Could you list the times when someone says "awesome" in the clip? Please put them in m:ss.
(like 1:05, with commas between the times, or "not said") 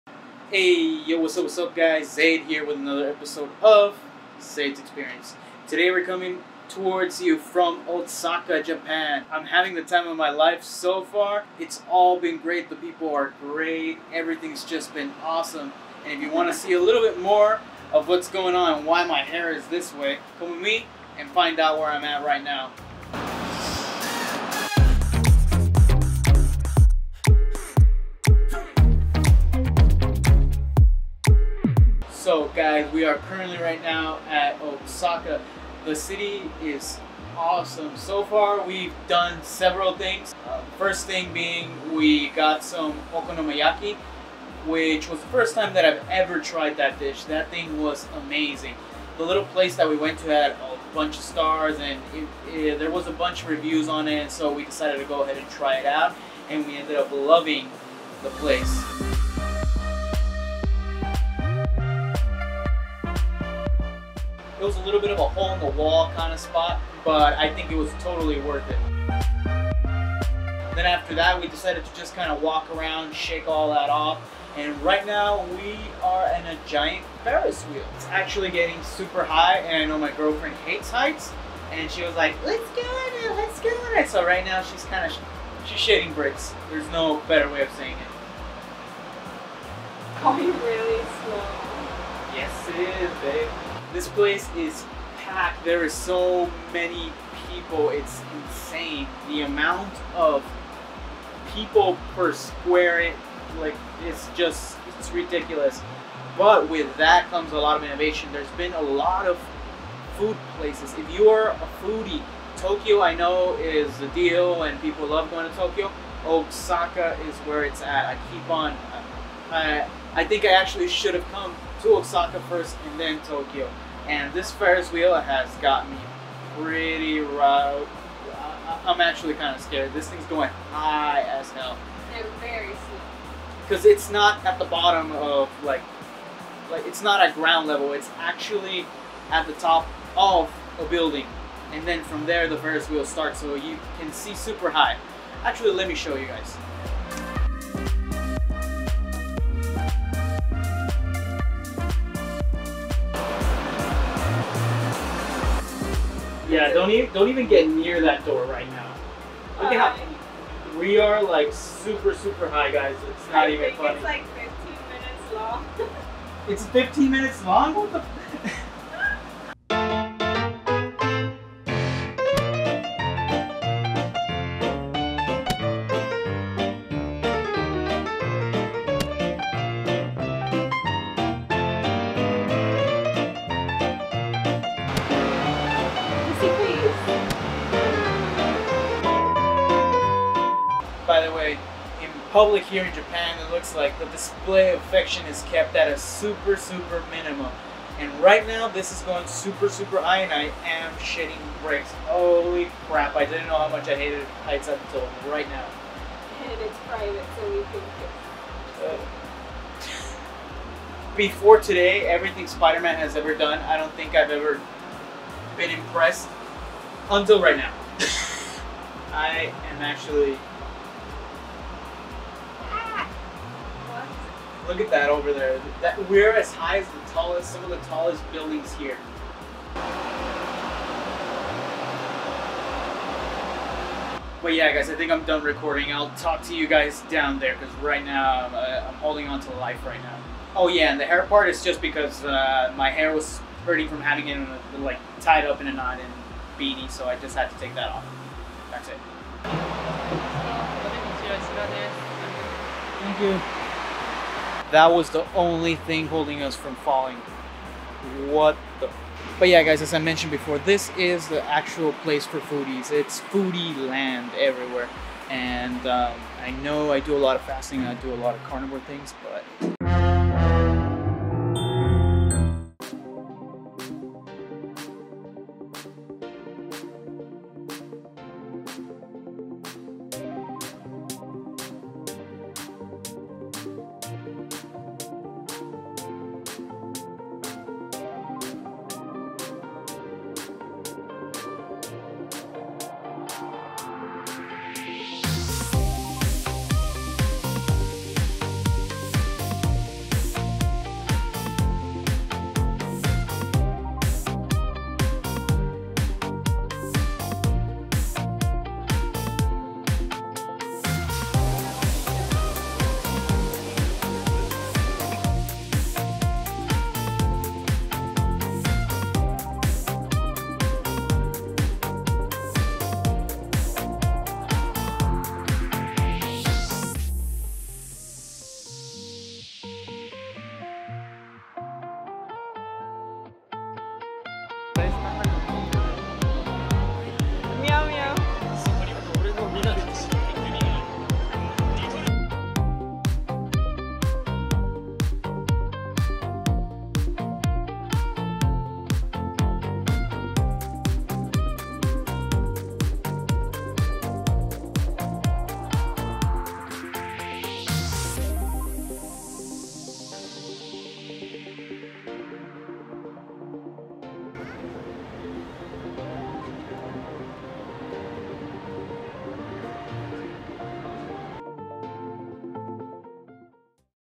0:15, 0:37.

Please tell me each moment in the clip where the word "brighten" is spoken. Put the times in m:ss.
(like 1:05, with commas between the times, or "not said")
not said.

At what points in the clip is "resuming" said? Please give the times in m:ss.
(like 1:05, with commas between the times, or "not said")
not said.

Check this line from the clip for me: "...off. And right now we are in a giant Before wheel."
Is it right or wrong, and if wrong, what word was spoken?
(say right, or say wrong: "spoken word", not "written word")
wrong: "Ferris", not "Before".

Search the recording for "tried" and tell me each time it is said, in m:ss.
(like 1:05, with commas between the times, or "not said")
0:46.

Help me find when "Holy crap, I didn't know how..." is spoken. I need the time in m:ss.
3:22.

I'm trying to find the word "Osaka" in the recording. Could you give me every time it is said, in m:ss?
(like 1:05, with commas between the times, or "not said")
0:07, 0:34, 1:56, 2:01.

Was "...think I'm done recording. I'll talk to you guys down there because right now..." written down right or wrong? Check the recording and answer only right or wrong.
right.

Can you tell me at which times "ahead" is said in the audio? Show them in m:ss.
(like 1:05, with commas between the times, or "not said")
0:55.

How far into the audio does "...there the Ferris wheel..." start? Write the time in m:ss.
2:22.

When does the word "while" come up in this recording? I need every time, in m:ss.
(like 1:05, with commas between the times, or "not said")
not said.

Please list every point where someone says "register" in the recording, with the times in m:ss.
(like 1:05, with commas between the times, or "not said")
not said.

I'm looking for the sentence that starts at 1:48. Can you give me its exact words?
There's been a lot of food places.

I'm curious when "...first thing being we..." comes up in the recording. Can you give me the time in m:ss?
0:40.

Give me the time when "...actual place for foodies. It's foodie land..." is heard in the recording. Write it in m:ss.
4:21.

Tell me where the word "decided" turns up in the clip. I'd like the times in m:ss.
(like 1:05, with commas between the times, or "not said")
0:54, 1:11.